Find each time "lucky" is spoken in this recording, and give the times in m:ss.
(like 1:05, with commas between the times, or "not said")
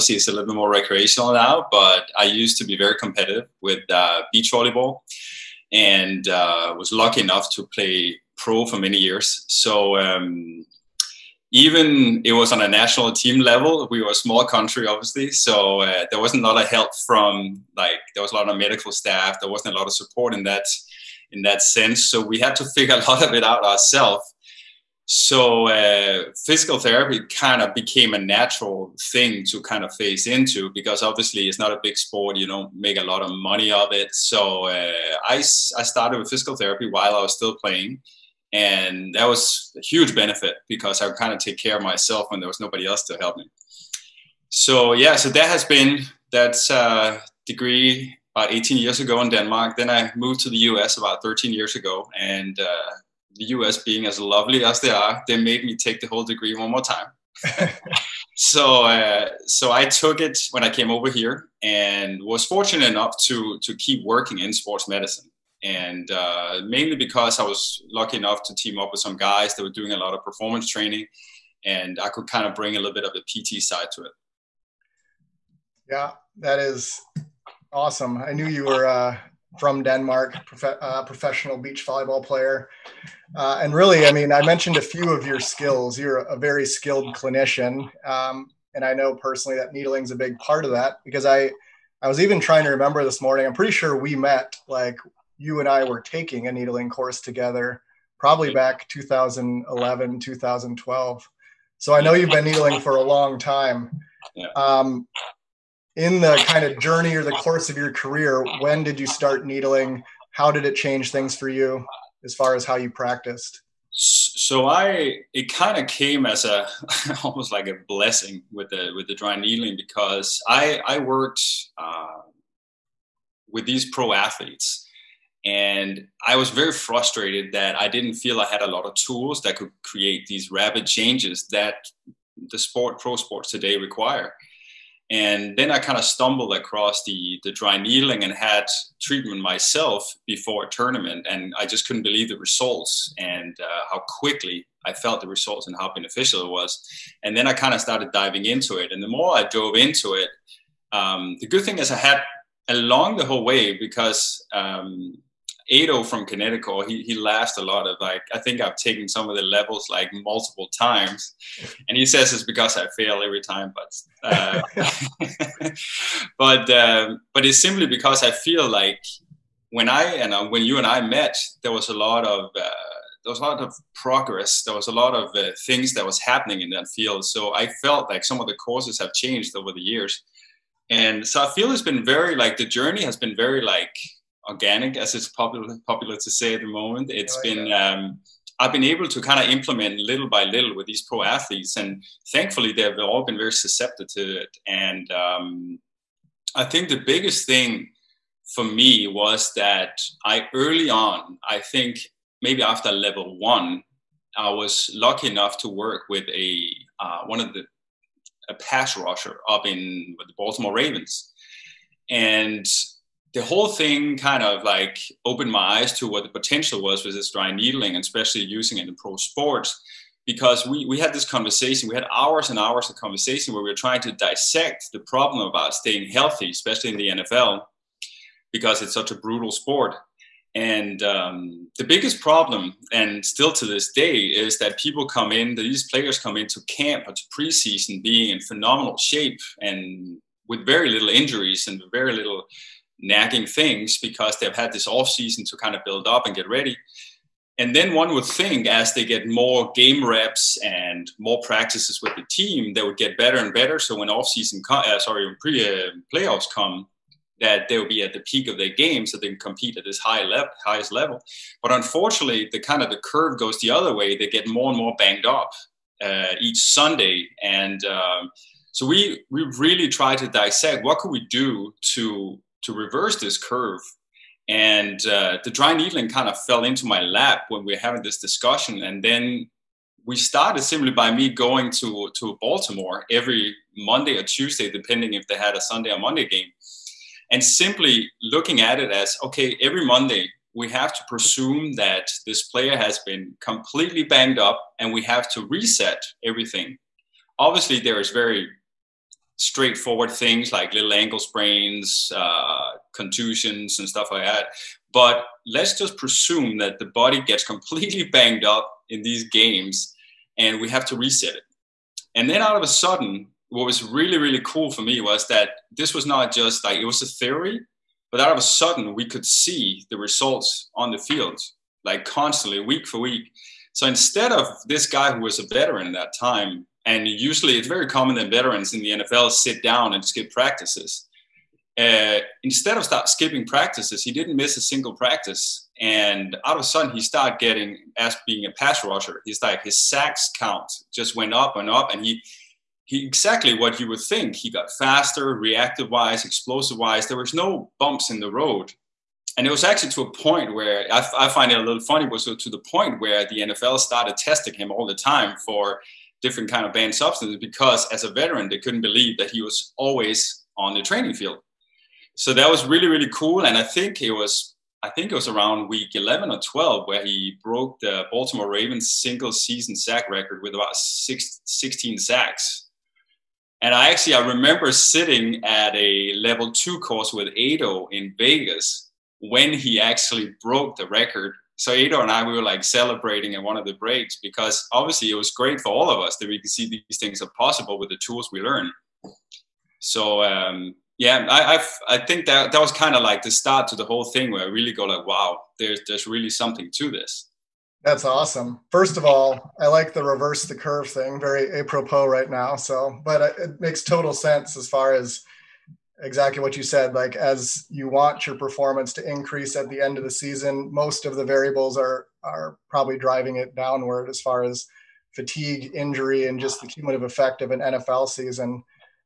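0:06, 1:07, 3:24.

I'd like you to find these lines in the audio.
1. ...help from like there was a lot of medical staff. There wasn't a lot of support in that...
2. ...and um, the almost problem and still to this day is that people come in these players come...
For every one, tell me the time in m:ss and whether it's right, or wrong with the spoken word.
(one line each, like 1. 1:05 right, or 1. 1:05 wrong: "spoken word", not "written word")
1. 0:16 right
2. 3:50 wrong: "biggest", not "almost".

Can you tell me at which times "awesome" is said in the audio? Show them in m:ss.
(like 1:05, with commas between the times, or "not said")
1:17, 6:38.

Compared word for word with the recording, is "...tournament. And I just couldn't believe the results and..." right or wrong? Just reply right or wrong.
right.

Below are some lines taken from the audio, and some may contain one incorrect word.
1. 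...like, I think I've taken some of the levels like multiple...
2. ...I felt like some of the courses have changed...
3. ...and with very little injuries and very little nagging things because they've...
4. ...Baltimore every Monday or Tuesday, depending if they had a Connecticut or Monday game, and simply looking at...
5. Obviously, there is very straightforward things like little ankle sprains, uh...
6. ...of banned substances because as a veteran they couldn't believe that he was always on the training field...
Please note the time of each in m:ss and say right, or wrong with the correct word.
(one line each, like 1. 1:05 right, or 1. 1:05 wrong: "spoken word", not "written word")
1. 2:37 right
2. 2:57 right
3. 3:59 right
4. 4:42 wrong: "Sunday", not "Connecticut"
5. 4:57 right
6. 5:56 right.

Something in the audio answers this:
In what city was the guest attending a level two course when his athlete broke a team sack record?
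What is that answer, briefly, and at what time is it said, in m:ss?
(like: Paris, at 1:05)
Vegas, at 6:18.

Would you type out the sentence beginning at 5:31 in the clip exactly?
Uh, instead of start skipping practices, he didn't miss a single practice.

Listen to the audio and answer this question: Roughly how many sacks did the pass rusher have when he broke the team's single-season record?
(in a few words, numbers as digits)
16.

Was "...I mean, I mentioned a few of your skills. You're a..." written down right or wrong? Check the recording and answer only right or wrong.
right.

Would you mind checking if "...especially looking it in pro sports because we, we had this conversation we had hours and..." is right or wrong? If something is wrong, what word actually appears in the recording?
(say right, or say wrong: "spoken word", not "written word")
wrong: "using", not "looking".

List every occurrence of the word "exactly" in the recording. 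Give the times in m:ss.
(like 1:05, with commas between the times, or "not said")
5:43, 6:46.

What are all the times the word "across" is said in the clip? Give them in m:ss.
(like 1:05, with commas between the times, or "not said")
2:16.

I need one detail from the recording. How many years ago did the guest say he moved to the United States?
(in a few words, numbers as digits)
13.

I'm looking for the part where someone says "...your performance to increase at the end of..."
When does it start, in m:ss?
6:48.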